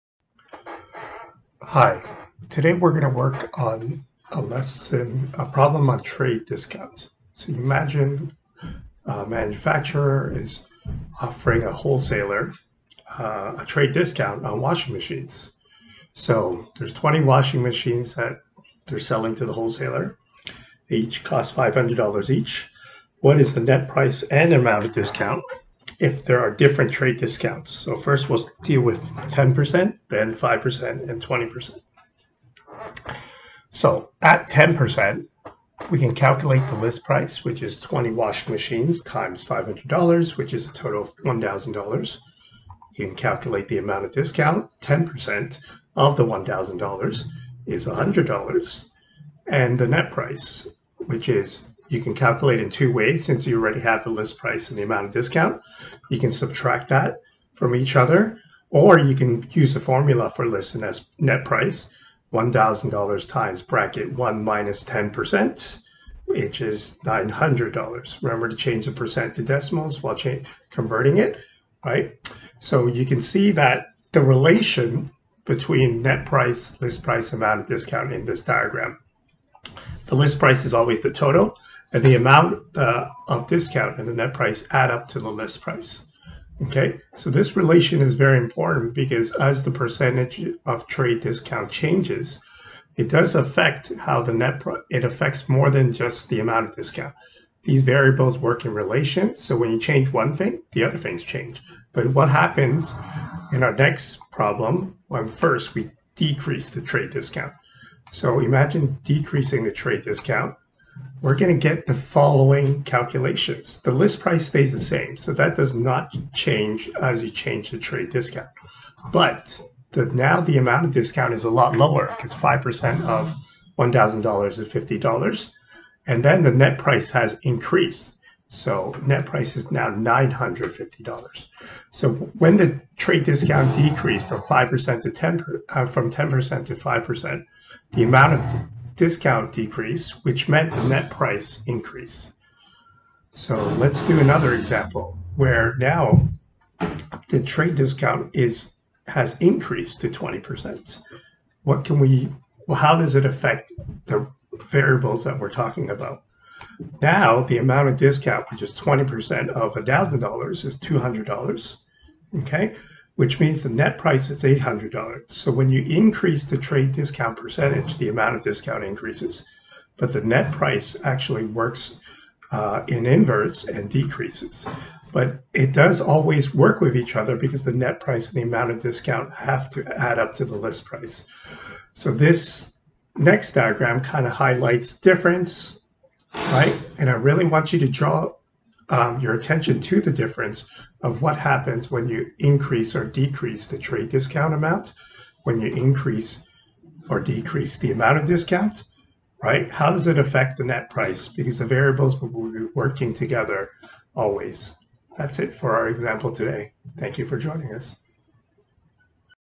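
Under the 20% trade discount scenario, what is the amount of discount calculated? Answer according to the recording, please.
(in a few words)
$200.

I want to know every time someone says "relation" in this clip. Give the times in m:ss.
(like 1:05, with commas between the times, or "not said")
1:14, 1:27, 1:38.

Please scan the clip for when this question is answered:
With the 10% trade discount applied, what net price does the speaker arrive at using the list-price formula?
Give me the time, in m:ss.
1:07.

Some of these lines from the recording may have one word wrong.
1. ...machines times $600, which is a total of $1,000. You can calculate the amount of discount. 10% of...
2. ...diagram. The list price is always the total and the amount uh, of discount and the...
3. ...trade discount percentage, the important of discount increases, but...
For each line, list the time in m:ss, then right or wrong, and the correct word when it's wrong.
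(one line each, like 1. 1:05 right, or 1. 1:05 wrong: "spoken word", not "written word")
1. 0:38 wrong: "500", not "600"
2. 1:18 right
3. 2:46 wrong: "amount", not "important".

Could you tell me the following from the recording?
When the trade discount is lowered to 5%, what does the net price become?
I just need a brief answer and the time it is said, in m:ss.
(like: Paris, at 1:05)
$950, at 2:09.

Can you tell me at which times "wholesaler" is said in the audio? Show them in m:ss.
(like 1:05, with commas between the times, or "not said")
0:11, 0:19.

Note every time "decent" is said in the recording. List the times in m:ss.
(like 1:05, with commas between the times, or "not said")
not said.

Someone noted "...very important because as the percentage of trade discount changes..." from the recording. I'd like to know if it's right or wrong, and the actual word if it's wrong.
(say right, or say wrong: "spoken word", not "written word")
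right.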